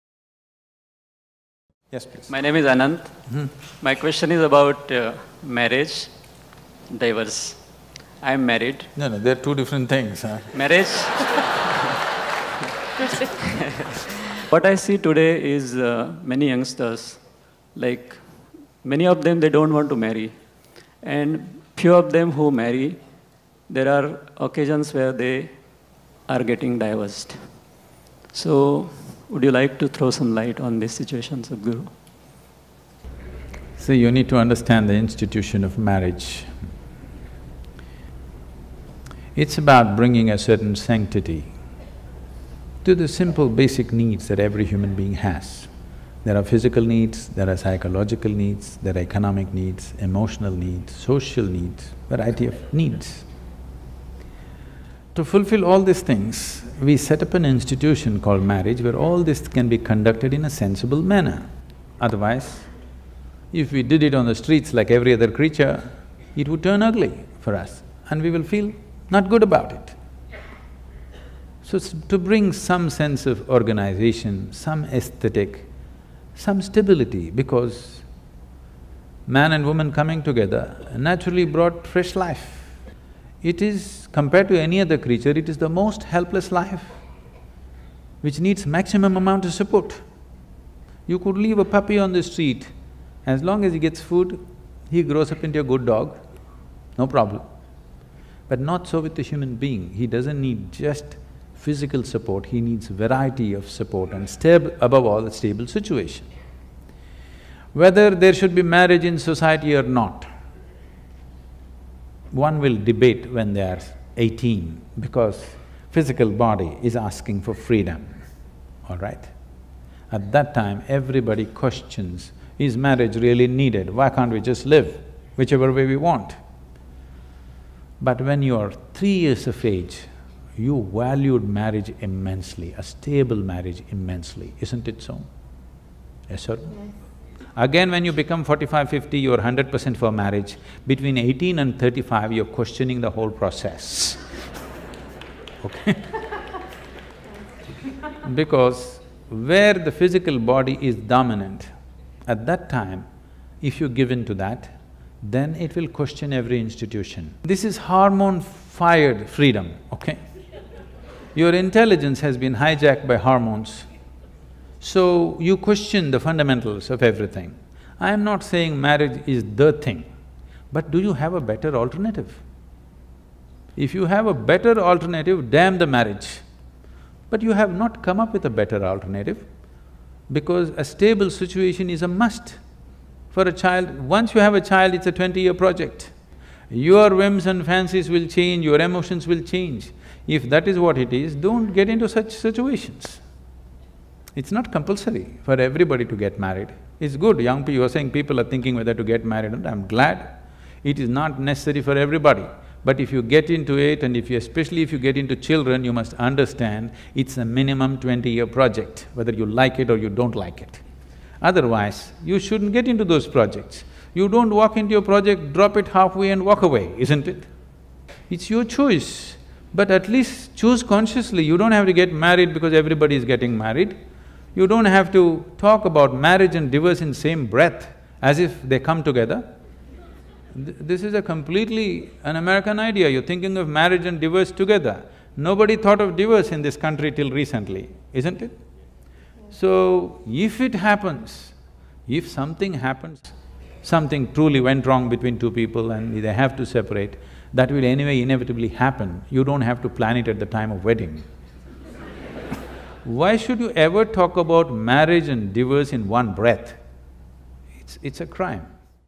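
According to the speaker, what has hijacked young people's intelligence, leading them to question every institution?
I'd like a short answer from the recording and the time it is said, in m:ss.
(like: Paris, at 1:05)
hormones, at 2:43.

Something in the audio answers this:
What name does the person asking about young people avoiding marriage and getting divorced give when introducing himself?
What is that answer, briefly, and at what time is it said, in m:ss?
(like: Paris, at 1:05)
Ananth, at 0:02.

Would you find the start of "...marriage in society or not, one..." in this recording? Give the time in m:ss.
1:48.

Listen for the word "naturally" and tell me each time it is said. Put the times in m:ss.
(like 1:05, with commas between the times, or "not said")
1:20.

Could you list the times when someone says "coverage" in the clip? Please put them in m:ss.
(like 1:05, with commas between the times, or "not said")
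not said.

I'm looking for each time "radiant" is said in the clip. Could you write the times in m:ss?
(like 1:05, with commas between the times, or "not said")
not said.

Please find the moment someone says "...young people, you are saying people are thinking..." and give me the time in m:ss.
3:17.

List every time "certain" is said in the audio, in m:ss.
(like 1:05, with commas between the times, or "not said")
0:40.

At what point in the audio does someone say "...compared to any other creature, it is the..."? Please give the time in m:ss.
1:24.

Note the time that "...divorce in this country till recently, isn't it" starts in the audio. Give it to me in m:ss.
3:56.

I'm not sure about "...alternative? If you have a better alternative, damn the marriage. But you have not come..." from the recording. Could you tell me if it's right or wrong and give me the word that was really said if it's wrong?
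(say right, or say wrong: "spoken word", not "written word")
right.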